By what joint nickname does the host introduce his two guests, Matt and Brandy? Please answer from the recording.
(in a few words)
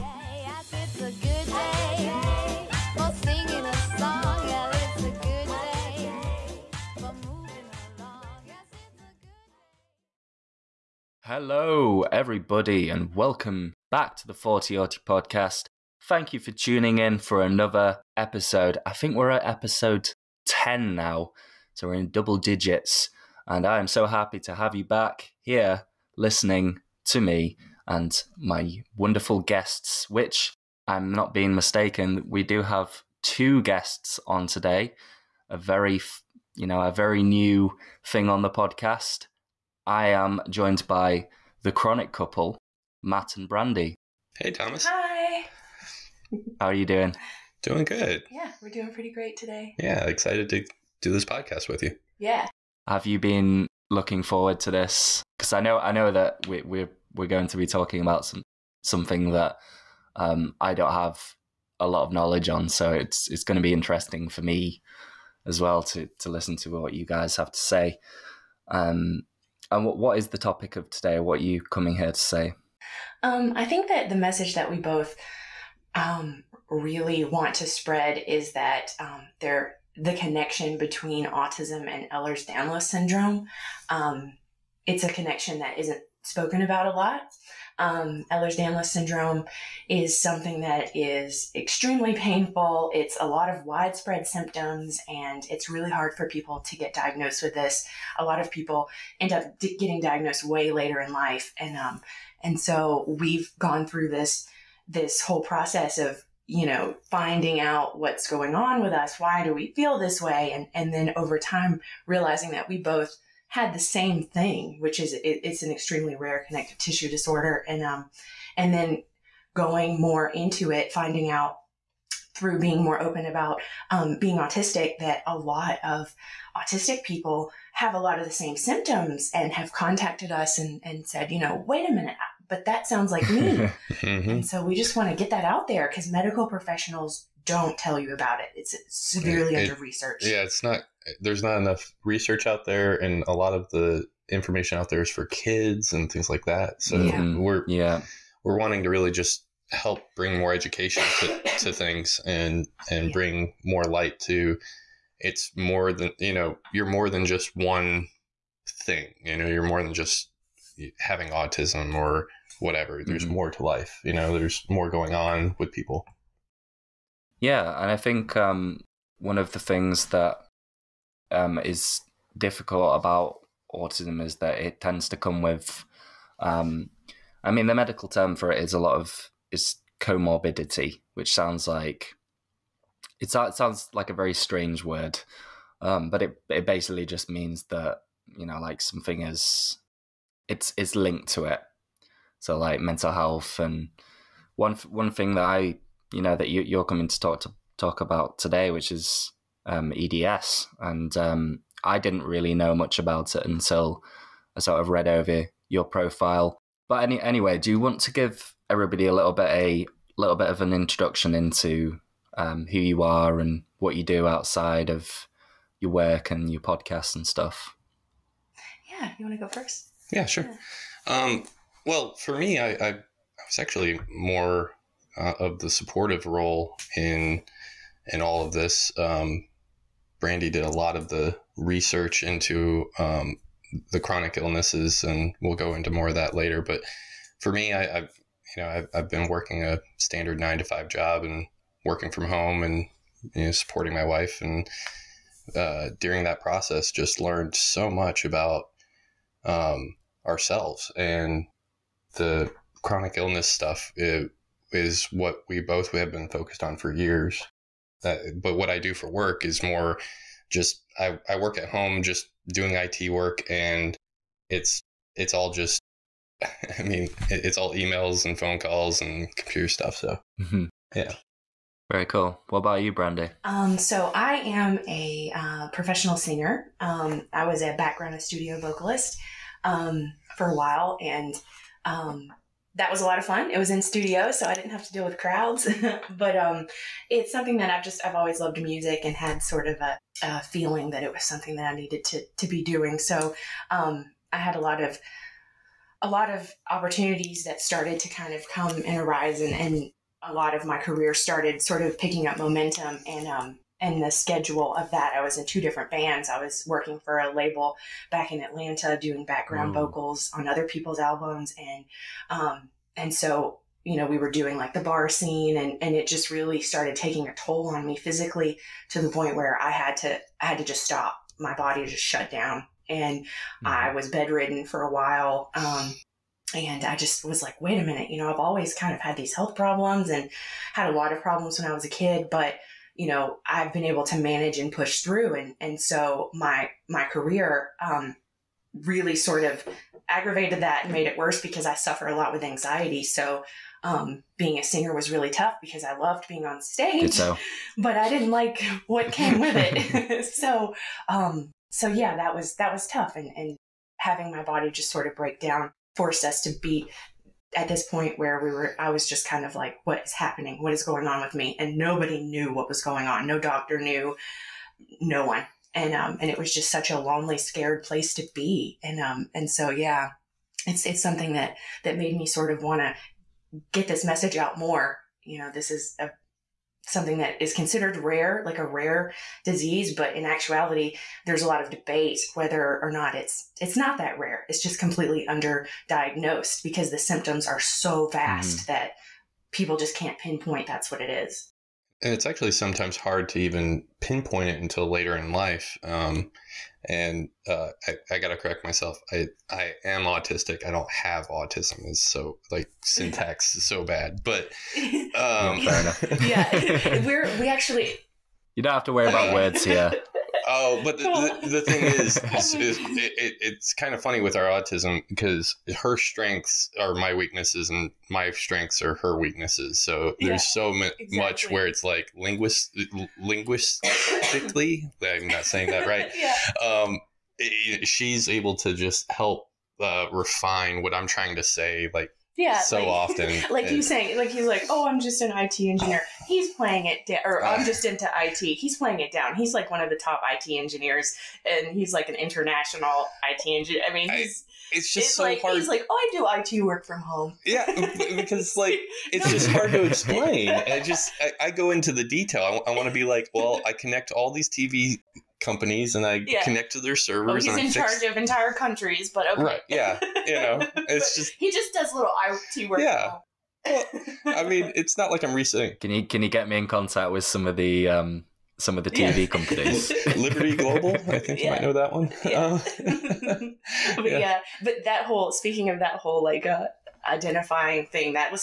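the chronic couple.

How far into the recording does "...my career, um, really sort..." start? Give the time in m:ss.
5:36.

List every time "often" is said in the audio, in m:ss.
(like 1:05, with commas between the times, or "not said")
7:12.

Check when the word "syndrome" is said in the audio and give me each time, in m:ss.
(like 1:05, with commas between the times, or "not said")
1:22, 1:28.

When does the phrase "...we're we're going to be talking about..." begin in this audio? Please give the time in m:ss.
0:56.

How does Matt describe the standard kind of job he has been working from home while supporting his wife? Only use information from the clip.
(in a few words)
nine to five job.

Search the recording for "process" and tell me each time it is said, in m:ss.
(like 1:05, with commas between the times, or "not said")
1:45, 4:06.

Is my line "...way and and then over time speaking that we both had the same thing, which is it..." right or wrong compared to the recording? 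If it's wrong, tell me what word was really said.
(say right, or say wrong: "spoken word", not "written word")
wrong: "realizing", not "speaking".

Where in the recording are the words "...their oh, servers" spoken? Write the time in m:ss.
7:36.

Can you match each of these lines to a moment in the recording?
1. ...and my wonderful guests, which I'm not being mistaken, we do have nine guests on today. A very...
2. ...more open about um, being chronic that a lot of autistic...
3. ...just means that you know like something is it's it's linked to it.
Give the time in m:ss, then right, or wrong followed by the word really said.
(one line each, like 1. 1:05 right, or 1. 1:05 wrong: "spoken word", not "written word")
1. 0:27 wrong: "two", not "nine"
2. 2:02 wrong: "autistic", not "chronic"
3. 3:07 right.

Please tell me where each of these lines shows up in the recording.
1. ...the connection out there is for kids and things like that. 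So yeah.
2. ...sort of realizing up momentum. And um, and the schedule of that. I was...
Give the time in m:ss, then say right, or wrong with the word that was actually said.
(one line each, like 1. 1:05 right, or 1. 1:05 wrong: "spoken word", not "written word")
1. 2:23 wrong: "information", not "connection"
2. 5:01 wrong: "picking", not "realizing".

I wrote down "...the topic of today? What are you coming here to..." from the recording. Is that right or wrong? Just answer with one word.
right.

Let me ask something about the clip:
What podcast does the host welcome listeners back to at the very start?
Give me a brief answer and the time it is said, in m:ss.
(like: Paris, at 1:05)
Thoughty Auti, at 0:14.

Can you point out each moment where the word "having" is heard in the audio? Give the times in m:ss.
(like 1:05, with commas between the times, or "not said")
2:40, 5:53.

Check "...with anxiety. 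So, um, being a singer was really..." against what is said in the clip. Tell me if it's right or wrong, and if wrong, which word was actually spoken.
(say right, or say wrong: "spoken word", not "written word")
right.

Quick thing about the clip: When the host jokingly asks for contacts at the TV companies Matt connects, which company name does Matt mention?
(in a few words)
Liberty Global.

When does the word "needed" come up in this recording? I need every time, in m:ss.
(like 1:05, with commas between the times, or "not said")
4:51.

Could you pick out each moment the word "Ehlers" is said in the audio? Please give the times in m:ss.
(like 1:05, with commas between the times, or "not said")
1:22, 1:28.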